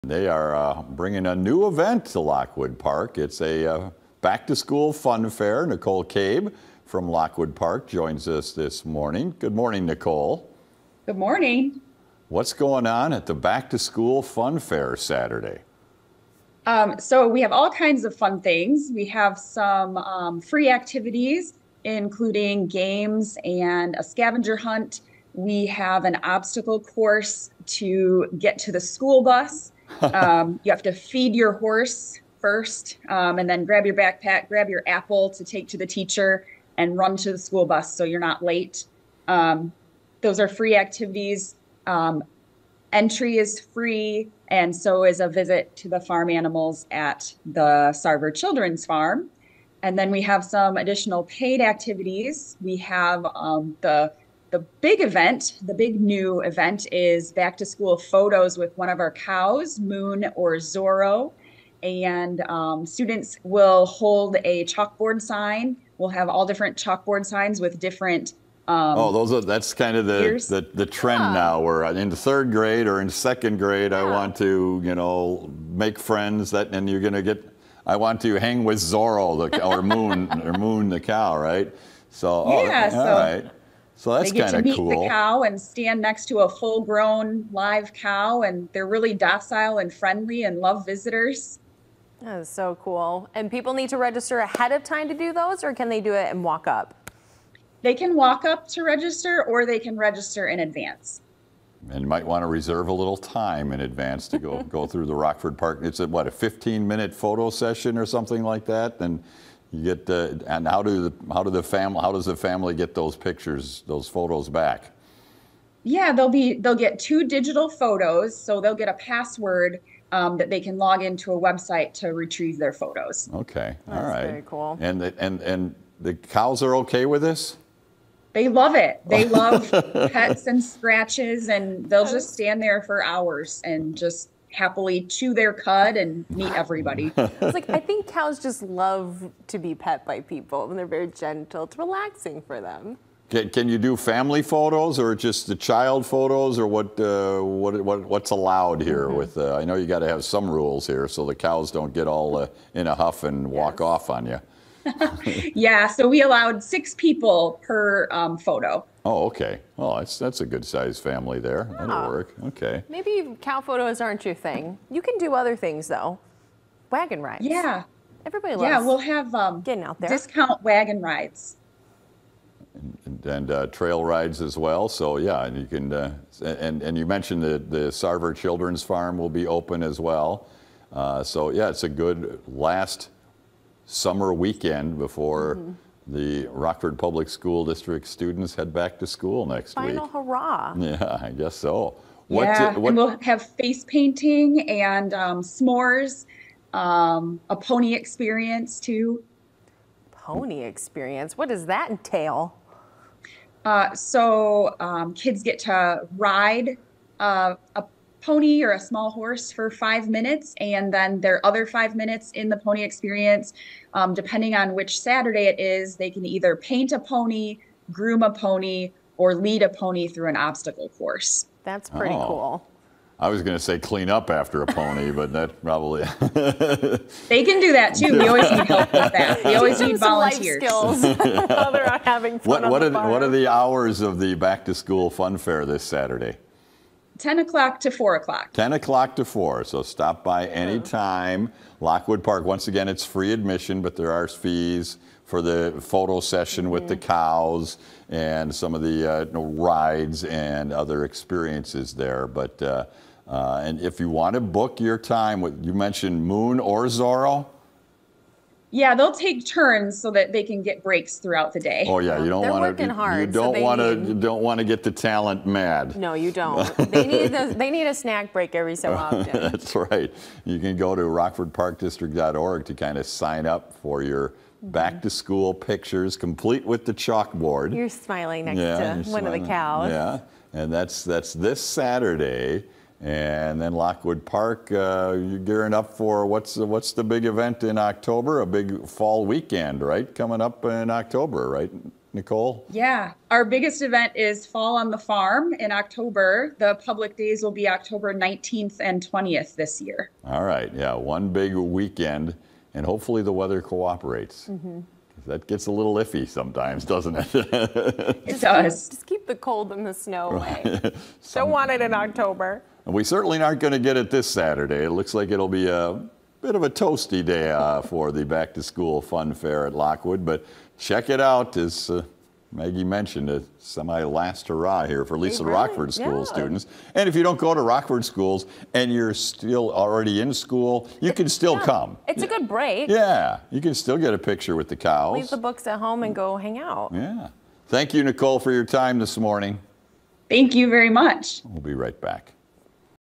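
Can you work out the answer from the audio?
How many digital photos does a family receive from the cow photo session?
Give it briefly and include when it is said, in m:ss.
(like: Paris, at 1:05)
2, at 1:56.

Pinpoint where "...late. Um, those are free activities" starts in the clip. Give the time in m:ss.
0:38.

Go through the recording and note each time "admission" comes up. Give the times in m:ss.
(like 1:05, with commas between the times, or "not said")
4:03.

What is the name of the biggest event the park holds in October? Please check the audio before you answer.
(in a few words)
Fall on the Farm.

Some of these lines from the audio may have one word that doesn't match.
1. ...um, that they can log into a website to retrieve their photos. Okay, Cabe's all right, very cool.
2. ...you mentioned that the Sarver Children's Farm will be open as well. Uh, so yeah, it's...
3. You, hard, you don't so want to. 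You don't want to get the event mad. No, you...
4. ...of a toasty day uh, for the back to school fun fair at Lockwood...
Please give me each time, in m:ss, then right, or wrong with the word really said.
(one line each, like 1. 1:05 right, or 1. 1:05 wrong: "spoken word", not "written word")
1. 2:00 wrong: "That", not "Cabe"
2. 2:56 right
3. 4:22 wrong: "talent", not "event"
4. 5:16 right.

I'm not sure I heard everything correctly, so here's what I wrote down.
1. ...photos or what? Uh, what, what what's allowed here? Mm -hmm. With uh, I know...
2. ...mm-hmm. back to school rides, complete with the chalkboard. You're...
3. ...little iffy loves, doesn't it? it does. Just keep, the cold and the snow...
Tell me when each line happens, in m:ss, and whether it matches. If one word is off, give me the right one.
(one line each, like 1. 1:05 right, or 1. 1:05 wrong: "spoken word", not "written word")
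1. 2:26 right
2. 4:34 wrong: "pictures", not "rides"
3. 5:05 wrong: "sometimes", not "loves".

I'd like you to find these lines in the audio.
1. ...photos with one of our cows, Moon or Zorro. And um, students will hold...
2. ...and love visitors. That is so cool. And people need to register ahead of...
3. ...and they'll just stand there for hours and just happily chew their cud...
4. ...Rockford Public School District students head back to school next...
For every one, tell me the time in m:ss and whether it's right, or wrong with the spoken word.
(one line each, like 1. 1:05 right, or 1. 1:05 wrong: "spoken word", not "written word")
1. 0:57 right
2. 1:30 right
3. 2:11 right
4. 3:06 right.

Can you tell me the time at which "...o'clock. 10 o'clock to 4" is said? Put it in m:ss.
3:58.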